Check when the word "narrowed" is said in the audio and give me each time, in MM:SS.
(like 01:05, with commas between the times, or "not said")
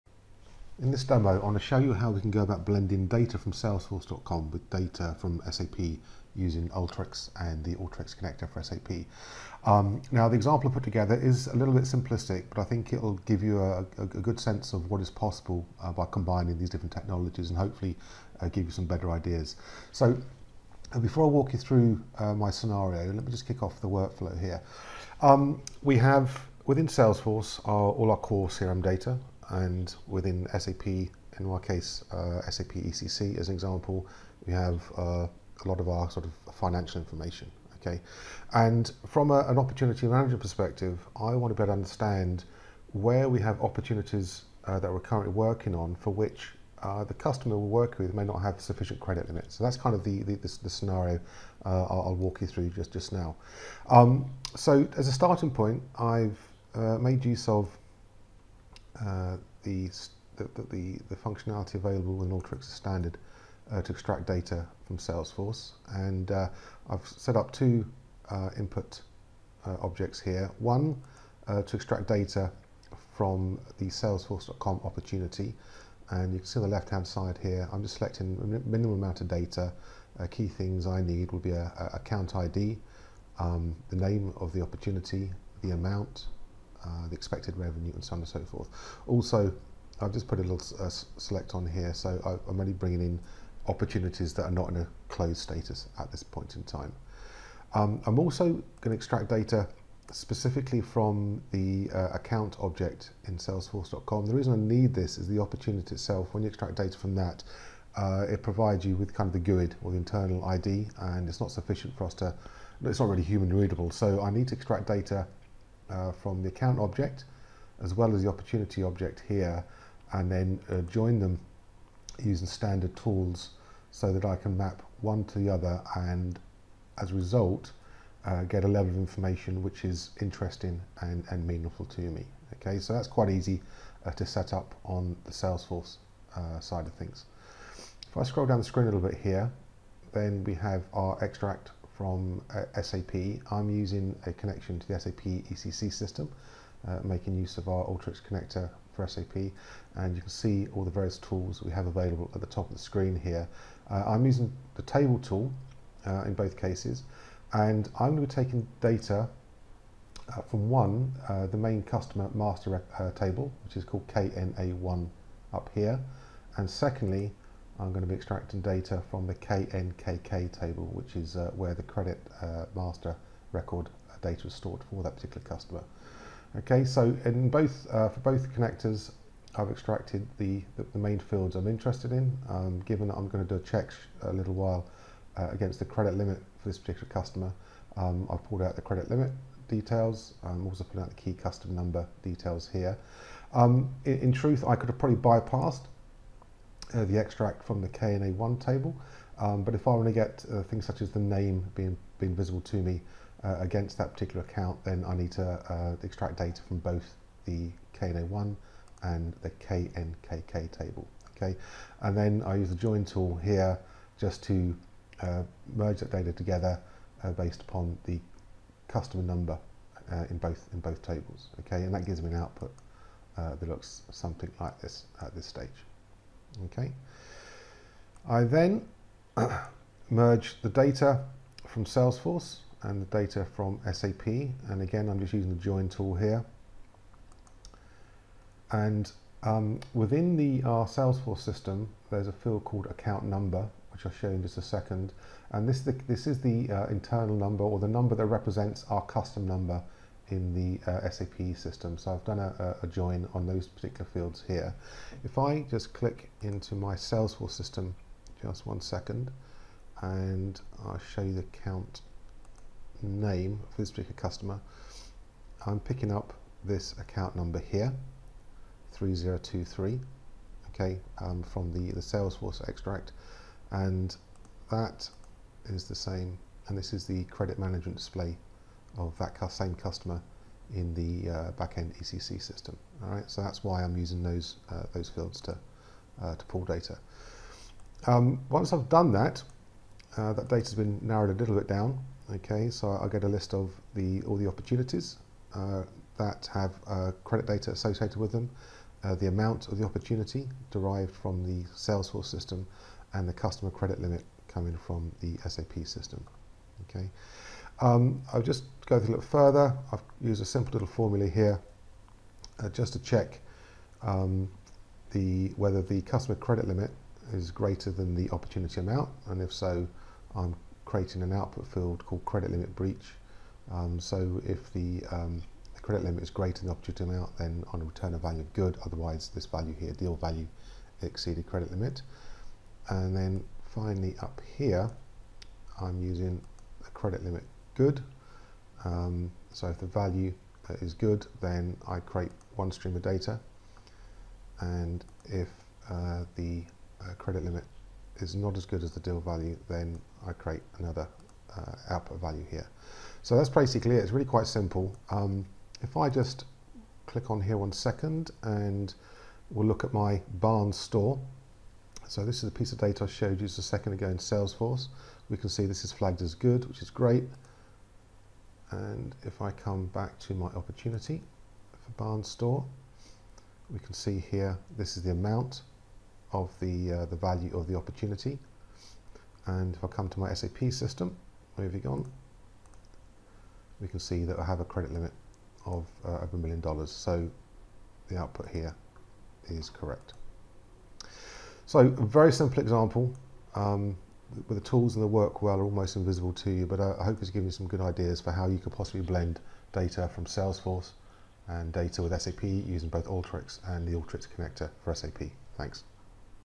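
04:51.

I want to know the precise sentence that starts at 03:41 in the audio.
Okay, and that gives me an output that looks something like this at this stage.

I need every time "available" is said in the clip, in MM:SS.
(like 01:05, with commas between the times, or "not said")
01:01, 02:31.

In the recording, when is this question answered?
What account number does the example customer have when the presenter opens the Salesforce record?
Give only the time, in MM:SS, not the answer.
04:28.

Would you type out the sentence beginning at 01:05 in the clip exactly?
And uh, I've set up two uh, input objects here.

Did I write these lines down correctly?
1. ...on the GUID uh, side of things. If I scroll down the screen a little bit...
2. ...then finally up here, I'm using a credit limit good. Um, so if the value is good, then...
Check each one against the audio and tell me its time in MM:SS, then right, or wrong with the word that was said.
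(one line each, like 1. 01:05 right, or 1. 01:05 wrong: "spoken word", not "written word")
1. 02:14 wrong: "Salesforce", not "GUID"
2. 05:33 right.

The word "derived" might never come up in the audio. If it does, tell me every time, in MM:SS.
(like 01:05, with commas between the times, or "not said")
05:00.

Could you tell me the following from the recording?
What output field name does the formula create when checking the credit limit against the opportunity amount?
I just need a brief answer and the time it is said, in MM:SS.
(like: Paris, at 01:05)
credit limit breach, at 05:22.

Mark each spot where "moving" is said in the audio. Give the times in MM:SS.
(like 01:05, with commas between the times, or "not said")
06:21.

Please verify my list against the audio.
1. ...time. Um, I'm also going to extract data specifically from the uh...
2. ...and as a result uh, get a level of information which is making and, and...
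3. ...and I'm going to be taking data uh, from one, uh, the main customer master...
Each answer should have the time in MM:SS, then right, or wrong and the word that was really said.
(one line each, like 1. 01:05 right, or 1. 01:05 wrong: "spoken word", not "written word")
1. 01:36 right
2. 02:05 wrong: "interesting", not "making"
3. 02:37 right.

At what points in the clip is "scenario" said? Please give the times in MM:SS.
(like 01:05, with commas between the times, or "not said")
00:22, 00:50.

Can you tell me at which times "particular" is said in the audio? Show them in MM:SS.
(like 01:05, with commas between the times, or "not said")
02:55, 03:06, 03:24, 04:13, 04:23.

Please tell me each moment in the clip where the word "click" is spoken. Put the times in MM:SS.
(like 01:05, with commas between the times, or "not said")
04:15, 05:57.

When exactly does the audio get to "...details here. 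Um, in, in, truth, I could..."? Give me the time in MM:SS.
03:12.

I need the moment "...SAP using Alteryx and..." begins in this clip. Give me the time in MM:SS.
00:05.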